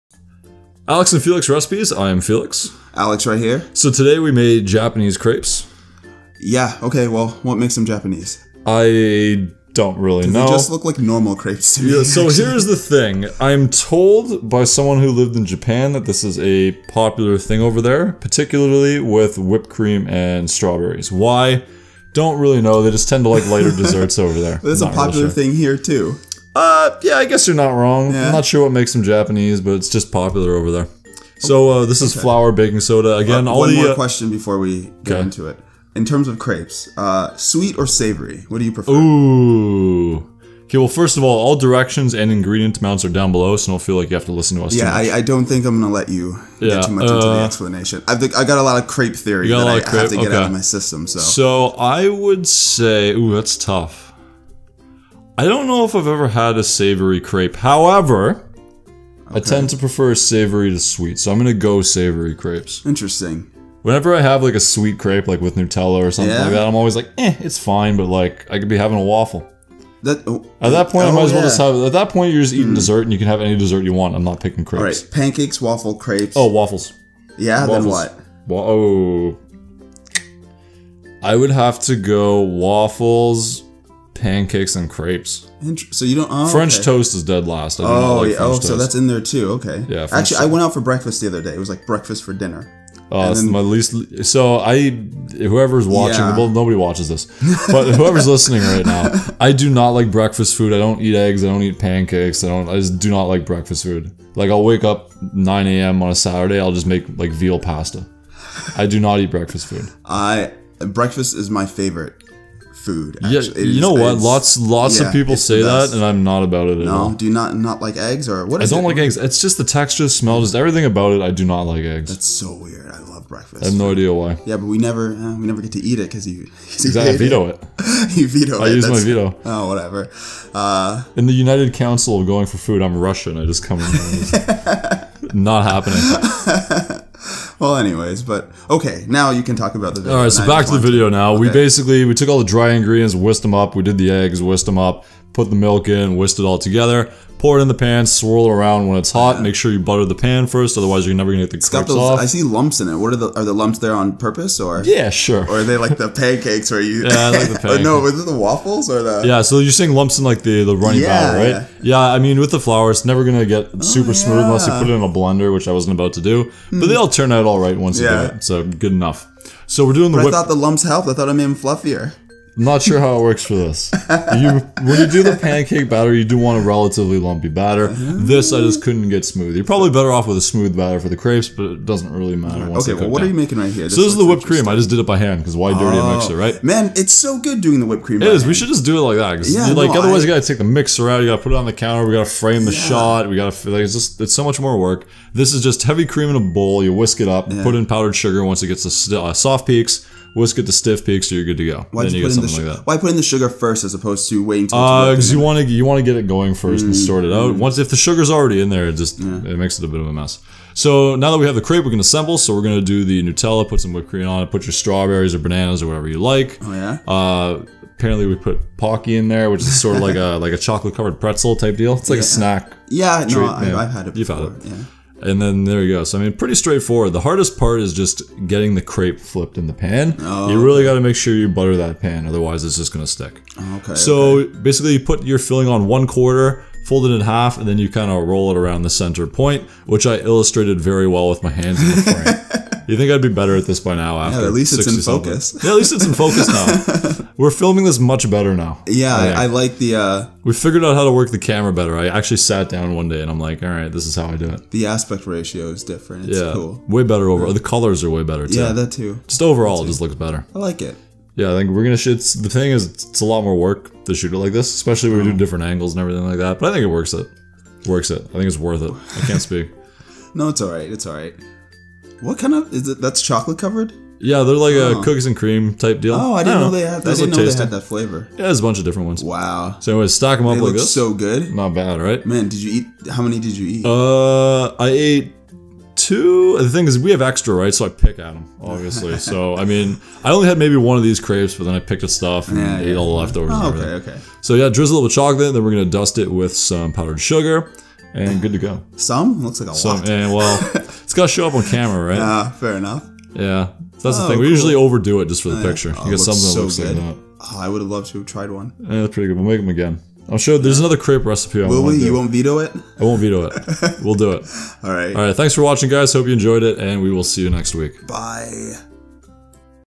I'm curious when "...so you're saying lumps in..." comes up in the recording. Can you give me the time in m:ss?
2:39.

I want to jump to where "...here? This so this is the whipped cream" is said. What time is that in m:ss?
3:03.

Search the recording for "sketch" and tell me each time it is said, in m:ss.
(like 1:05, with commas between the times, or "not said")
not said.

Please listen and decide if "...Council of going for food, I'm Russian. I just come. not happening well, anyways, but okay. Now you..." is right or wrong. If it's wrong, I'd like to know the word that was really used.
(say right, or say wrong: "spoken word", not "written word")
right.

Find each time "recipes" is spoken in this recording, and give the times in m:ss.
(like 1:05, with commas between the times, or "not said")
0:01, 5:11.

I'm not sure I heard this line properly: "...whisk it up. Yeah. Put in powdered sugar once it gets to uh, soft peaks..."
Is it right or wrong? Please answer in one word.
right.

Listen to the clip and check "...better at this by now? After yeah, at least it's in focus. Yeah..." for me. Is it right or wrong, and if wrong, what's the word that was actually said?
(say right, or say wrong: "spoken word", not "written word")
right.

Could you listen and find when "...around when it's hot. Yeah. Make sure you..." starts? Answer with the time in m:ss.
2:28.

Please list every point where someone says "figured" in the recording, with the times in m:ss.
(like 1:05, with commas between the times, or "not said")
4:10.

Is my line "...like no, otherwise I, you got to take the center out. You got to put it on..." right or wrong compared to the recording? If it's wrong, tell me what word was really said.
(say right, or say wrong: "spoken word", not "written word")
wrong: "mixer", not "center".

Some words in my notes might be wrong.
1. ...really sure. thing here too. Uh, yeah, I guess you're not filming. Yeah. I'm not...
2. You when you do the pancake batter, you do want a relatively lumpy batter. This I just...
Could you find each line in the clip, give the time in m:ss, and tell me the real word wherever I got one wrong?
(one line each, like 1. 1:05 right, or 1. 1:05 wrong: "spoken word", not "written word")
1. 0:25 wrong: "wrong", not "filming"
2. 2:54 right.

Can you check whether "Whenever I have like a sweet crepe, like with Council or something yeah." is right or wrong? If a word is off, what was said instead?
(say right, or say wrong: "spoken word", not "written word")
wrong: "Nutella", not "Council".